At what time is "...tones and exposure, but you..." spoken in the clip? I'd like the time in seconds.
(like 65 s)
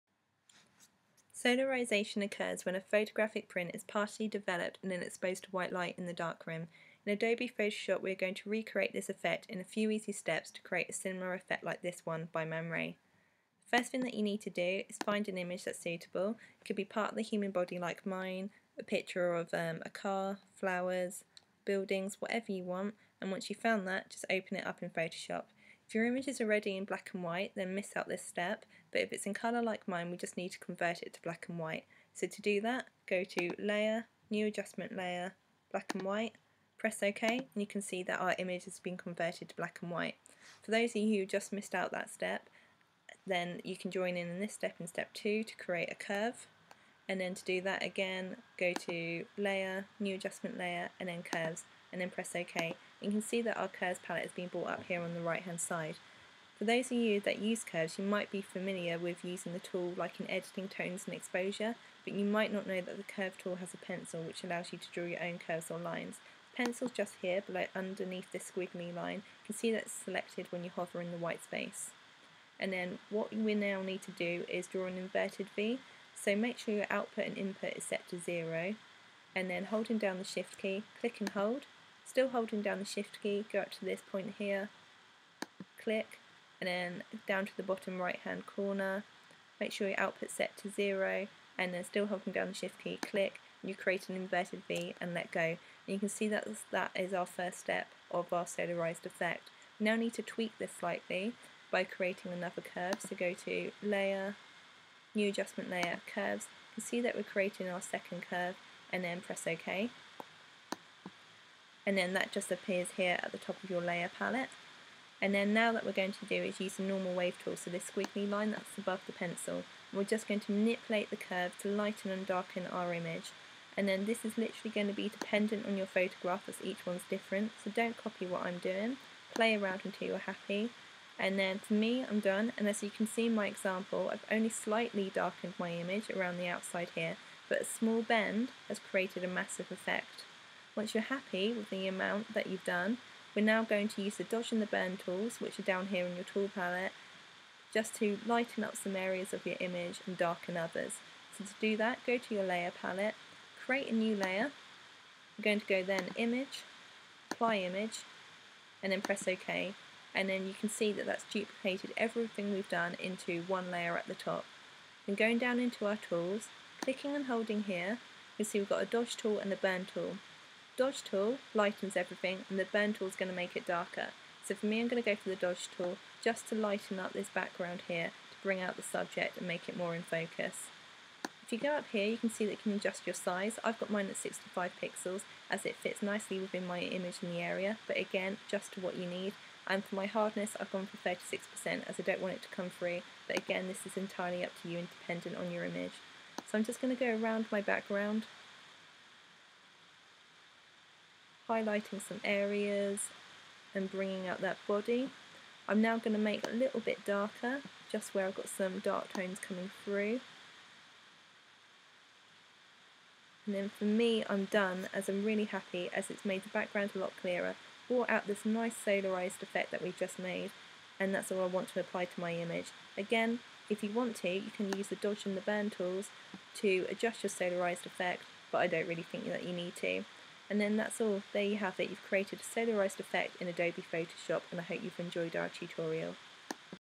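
60 s.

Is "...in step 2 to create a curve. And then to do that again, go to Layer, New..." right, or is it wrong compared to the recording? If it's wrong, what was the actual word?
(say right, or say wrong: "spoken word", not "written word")
right.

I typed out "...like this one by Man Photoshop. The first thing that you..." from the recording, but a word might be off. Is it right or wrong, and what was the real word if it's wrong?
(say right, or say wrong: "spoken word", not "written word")
wrong: "Ray", not "Photoshop".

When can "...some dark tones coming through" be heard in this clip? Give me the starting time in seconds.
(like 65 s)
208 s.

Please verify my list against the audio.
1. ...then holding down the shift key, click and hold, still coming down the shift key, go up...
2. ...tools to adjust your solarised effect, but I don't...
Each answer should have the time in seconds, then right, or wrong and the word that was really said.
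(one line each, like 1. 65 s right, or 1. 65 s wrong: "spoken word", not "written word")
1. 79 s wrong: "holding", not "coming"
2. 225 s right.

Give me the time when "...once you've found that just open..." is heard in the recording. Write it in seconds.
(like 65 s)
23 s.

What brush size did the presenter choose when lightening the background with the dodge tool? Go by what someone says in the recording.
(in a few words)
65 pixels.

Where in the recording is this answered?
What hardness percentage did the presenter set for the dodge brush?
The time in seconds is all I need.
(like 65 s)
191 s.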